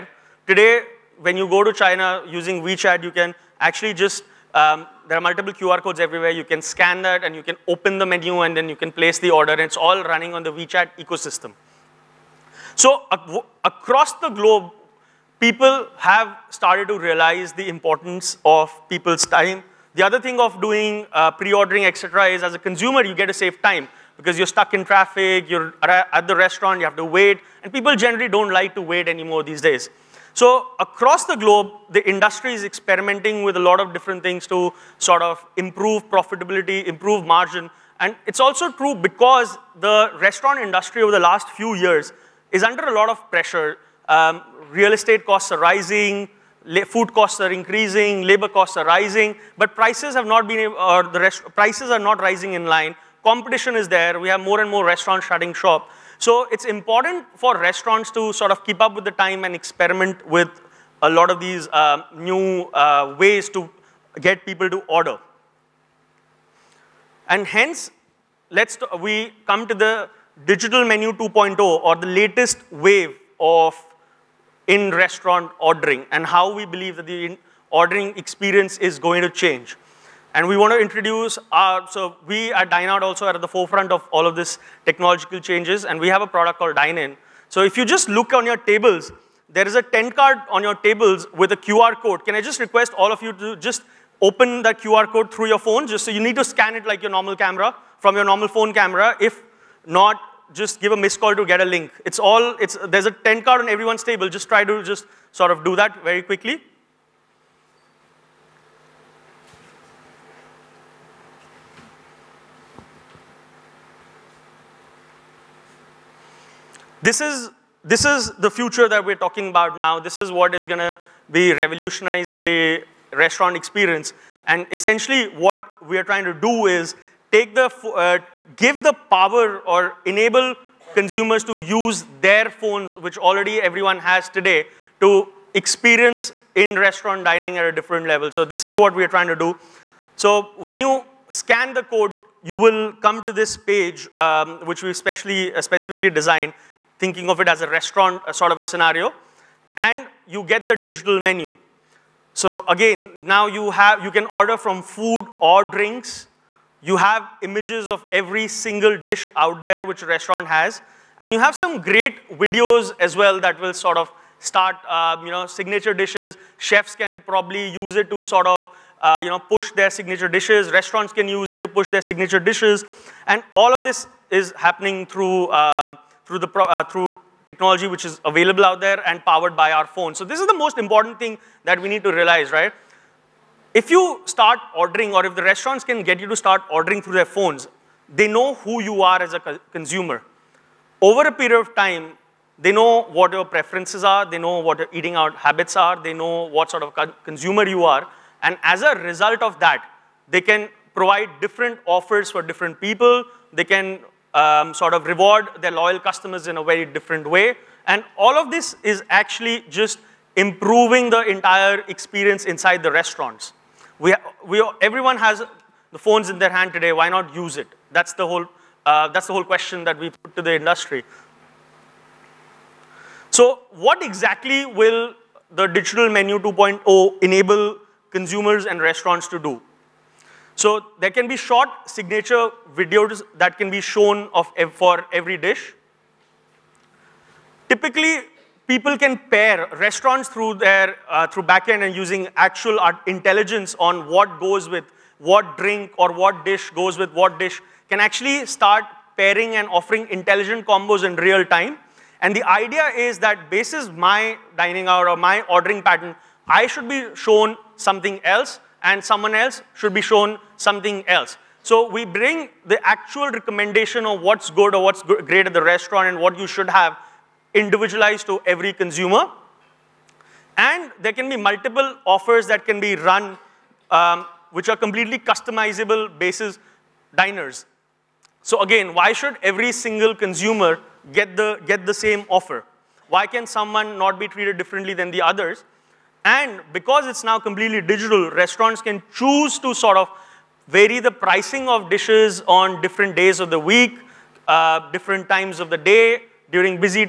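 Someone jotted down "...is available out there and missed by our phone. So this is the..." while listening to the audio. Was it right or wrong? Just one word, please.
wrong.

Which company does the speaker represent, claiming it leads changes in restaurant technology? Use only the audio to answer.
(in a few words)
Dineout.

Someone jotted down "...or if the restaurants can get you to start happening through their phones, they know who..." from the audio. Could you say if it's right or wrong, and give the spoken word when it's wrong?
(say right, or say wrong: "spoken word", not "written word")
wrong: "ordering", not "happening".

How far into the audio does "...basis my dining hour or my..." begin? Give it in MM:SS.
04:13.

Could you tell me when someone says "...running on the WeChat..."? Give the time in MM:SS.
00:10.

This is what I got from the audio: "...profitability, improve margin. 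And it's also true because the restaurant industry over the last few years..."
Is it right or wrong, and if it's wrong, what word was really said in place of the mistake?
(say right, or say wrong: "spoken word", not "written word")
right.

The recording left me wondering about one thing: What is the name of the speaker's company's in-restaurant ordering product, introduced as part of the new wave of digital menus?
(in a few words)
Dinin.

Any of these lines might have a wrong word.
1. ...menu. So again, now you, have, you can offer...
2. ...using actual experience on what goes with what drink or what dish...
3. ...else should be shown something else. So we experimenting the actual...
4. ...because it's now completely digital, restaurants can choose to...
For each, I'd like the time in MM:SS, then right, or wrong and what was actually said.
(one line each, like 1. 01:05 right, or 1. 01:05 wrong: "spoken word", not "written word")
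1. 02:31 wrong: "order", not "offer"
2. 04:01 wrong: "intelligence", not "experience"
3. 04:19 wrong: "bring", not "experimenting"
4. 04:46 right.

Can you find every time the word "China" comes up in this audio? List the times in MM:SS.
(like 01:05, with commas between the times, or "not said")
00:01.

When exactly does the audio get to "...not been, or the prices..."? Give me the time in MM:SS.
00:50.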